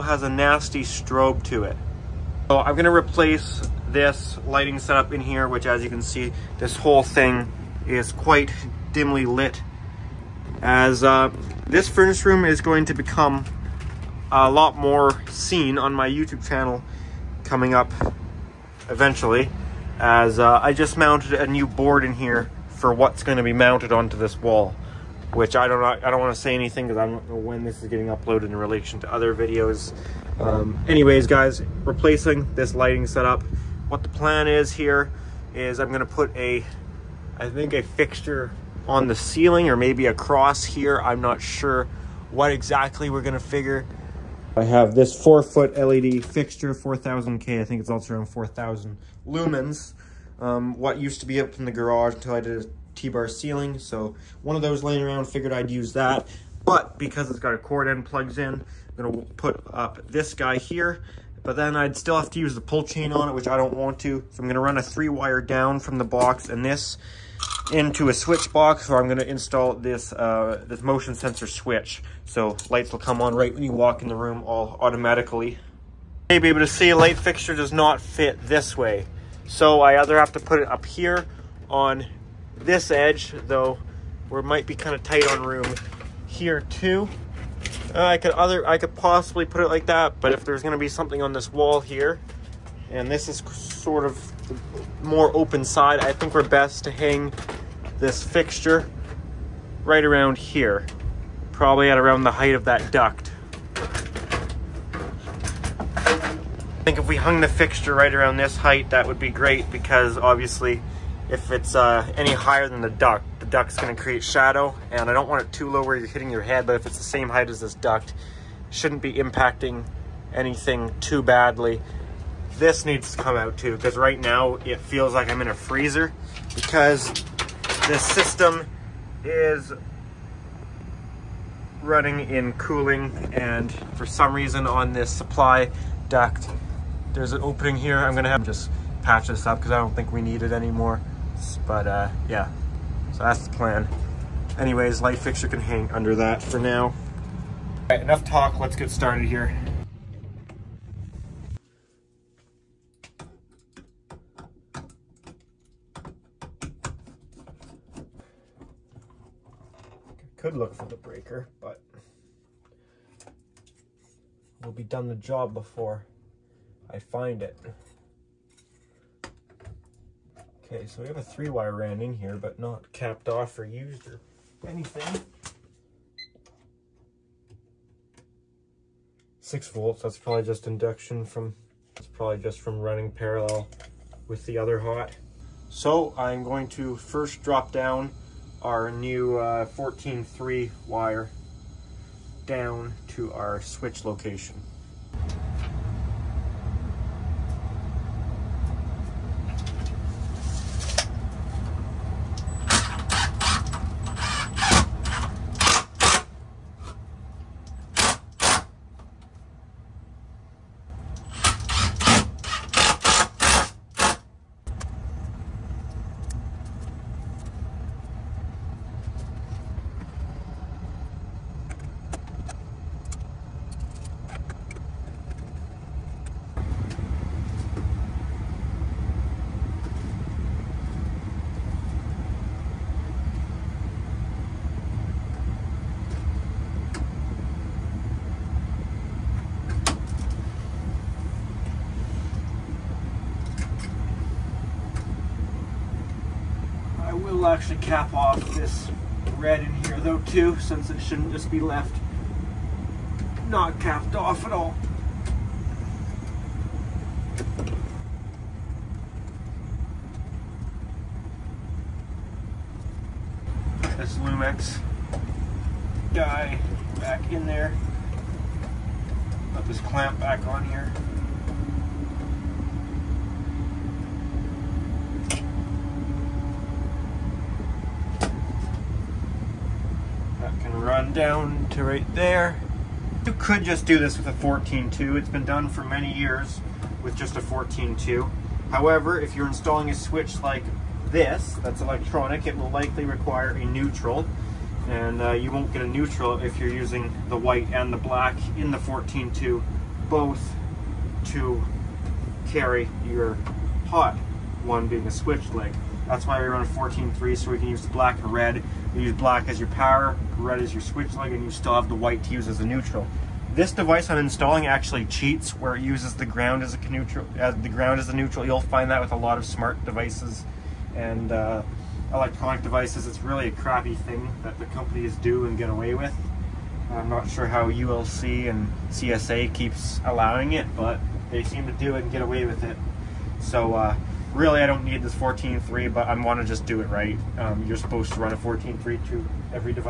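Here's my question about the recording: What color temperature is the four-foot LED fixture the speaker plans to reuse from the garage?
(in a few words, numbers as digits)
4000K.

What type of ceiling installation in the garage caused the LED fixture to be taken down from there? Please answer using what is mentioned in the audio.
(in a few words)
T-bar ceiling.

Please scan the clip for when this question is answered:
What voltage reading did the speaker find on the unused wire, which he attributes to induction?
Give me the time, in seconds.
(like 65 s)
179 s.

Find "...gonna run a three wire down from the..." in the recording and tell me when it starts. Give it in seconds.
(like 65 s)
64 s.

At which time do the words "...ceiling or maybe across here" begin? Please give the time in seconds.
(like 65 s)
39 s.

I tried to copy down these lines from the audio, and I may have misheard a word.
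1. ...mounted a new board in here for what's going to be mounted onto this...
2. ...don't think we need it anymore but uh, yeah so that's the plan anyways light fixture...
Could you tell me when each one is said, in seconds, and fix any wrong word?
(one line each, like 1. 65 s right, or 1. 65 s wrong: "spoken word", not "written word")
1. 20 s right
2. 139 s right.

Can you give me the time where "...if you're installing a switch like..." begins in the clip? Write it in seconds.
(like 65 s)
289 s.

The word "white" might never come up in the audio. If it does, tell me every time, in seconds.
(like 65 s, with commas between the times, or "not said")
297 s, 311 s.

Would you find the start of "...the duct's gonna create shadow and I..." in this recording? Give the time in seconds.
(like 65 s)
113 s.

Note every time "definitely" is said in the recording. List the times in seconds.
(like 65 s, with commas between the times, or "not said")
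not said.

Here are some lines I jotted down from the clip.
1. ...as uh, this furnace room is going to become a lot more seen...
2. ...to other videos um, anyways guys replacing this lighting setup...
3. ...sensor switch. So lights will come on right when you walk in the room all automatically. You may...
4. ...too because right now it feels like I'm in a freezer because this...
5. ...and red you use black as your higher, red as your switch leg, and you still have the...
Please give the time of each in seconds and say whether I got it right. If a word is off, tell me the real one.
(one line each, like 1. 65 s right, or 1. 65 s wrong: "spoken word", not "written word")
1. 10 s right
2. 29 s right
3. 71 s right
4. 123 s right
5. 308 s wrong: "power", not "higher".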